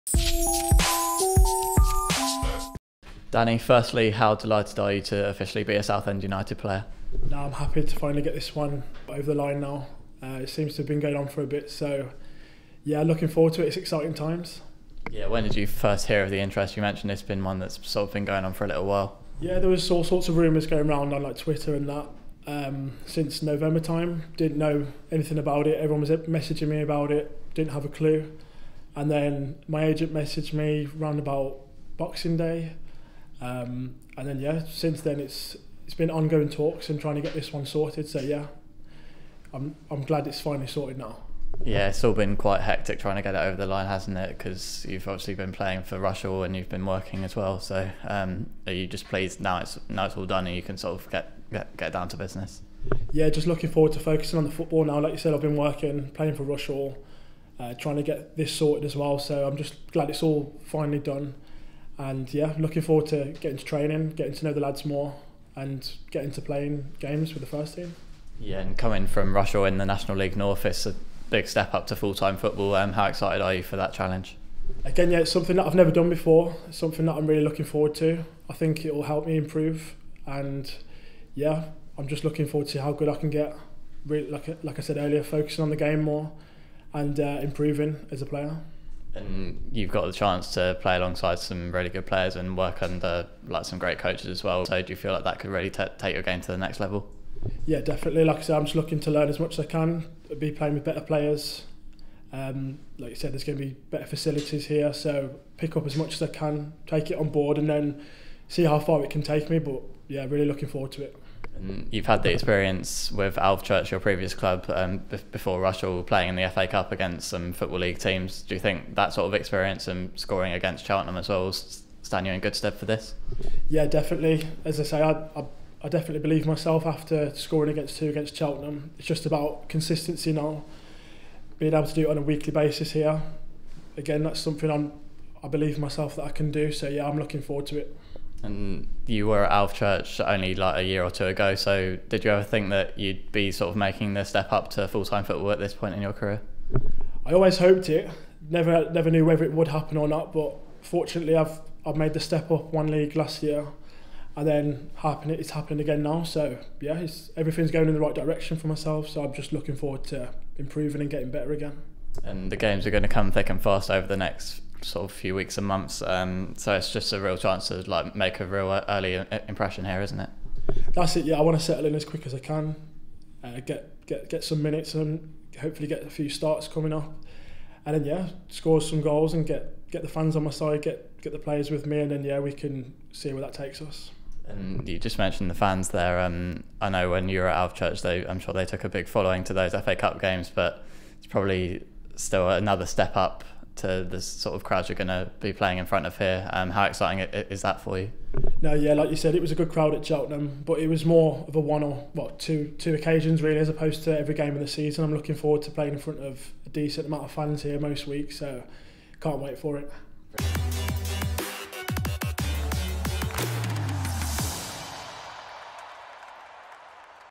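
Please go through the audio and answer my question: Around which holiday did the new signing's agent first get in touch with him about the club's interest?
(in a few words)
Boxing Day.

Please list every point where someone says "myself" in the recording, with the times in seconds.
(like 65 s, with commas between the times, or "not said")
126 s, 135 s, 158 s.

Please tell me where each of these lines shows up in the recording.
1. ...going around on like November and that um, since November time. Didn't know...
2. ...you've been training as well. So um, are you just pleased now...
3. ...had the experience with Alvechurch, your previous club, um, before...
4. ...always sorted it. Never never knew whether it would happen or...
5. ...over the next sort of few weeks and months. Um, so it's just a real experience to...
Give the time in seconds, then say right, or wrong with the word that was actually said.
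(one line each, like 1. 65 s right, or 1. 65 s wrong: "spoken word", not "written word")
1. 20 s wrong: "Twitter", not "November"
2. 46 s wrong: "working", not "training"
3. 112 s right
4. 147 s wrong: "hoped", not "sorted"
5. 163 s wrong: "chance", not "experience".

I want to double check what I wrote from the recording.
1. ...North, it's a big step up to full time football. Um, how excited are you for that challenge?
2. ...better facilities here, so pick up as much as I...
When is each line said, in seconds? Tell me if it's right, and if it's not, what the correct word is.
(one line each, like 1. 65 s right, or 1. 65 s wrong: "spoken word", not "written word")
1. 70 s right
2. 103 s right.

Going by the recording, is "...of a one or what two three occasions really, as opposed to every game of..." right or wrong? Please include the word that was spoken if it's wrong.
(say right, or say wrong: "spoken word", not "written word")
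wrong: "two", not "three".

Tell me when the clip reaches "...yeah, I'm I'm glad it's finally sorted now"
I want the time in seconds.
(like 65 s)
38 s.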